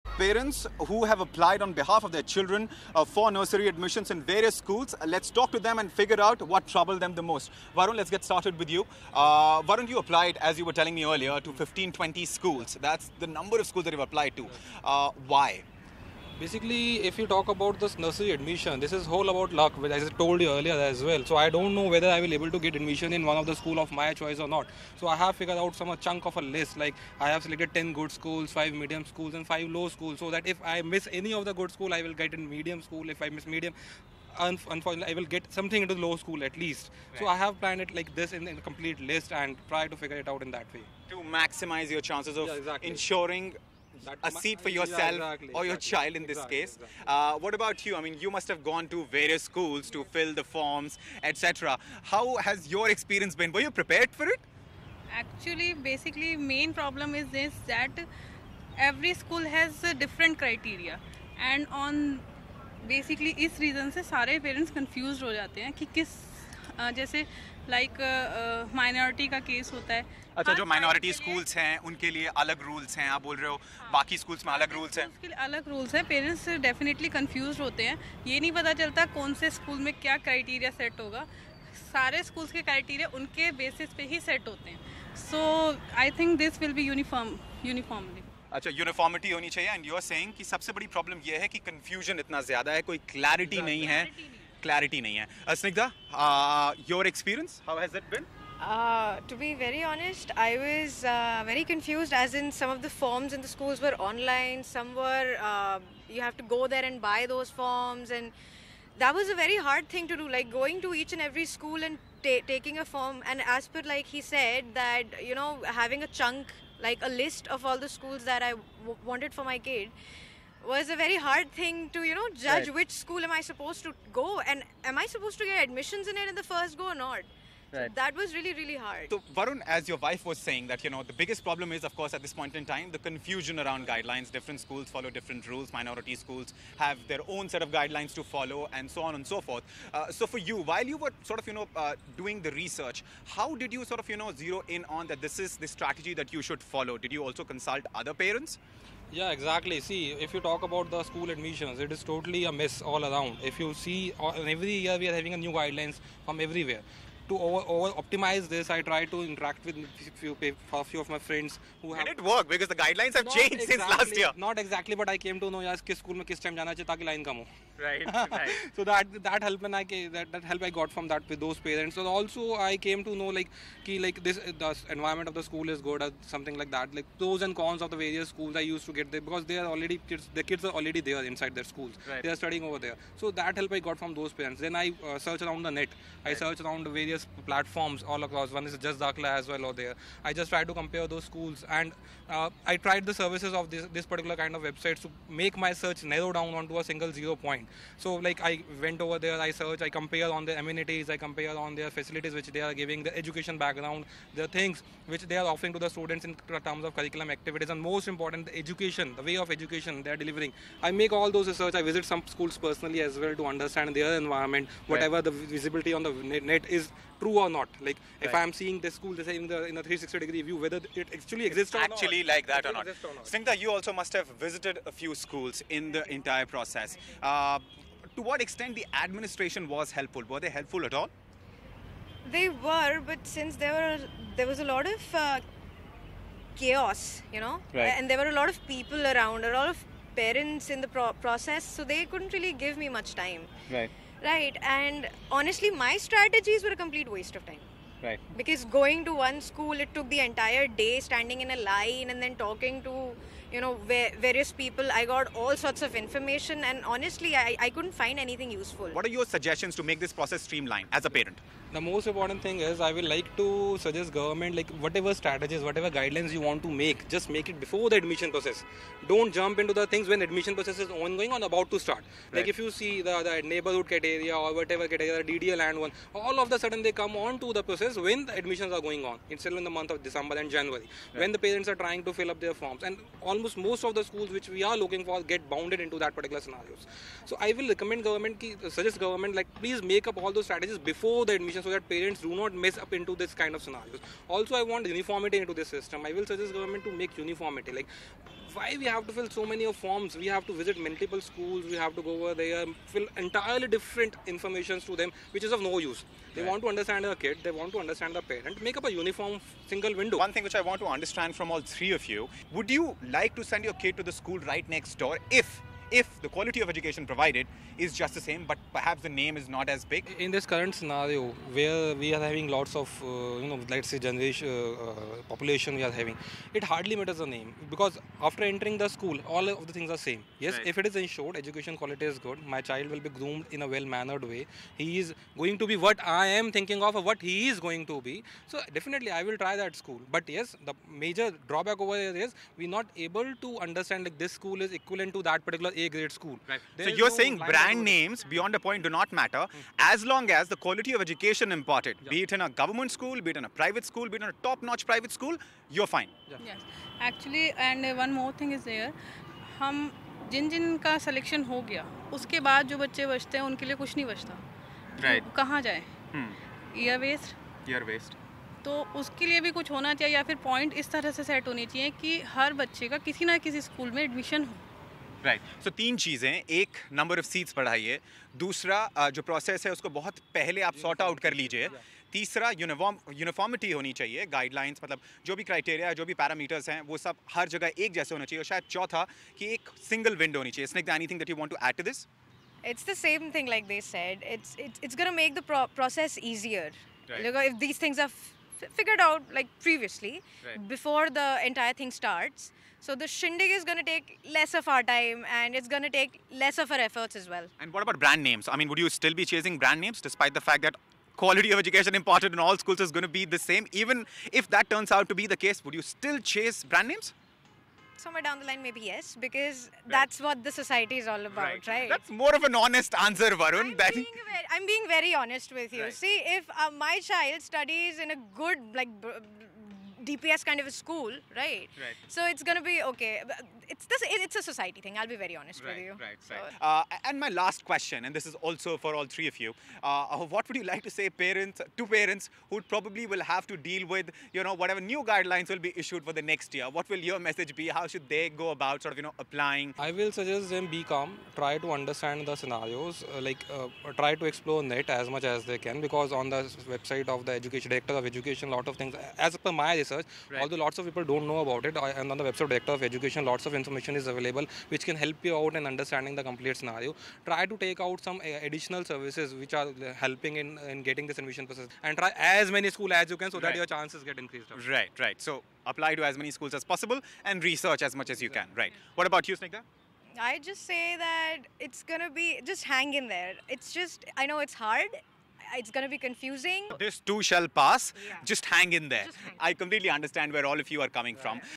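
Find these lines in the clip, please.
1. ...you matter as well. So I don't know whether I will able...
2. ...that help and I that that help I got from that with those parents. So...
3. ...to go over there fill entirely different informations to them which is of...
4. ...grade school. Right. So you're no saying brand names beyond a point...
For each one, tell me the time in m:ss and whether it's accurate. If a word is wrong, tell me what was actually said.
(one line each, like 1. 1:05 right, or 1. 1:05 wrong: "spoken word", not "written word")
1. 0:20 wrong: "earlier", not "matter"
2. 2:49 right
3. 5:01 right
4. 5:45 right.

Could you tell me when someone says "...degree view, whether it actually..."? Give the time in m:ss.
3:40.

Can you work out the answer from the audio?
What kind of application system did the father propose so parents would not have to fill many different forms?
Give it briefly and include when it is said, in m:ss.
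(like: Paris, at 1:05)
single window, at 5:09.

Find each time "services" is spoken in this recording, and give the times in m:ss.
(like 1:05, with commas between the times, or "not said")
3:13, 7:48.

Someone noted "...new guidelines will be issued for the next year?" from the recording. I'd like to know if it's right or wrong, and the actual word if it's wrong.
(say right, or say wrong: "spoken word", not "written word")
right.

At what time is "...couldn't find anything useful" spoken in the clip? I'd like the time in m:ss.
4:17.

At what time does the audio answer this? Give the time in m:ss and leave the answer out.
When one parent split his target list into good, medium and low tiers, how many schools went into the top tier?
0:27.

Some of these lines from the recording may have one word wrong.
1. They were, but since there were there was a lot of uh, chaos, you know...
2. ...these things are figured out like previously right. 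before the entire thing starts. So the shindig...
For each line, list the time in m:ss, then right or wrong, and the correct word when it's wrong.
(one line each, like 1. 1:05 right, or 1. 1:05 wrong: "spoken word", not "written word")
1. 3:52 right
2. 6:37 right.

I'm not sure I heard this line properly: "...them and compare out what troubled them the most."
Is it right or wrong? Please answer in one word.
wrong.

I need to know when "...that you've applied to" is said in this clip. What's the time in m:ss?
0:13.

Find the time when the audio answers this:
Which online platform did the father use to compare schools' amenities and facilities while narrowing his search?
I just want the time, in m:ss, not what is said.
3:08.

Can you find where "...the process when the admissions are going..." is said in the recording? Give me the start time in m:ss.
4:37.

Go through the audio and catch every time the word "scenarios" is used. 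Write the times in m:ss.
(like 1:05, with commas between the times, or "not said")
4:46, 4:53, 5:20, 7:32, 7:46.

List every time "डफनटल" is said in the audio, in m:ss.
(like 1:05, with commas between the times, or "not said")
1:16.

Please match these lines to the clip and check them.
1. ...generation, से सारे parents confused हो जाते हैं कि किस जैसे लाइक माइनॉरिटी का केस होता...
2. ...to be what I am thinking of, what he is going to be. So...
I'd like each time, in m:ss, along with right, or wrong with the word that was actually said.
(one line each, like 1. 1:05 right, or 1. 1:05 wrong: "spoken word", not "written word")
1. 1:03 wrong: "reason", not "generation"
2. 5:35 right.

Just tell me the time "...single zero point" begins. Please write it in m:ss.
3:16.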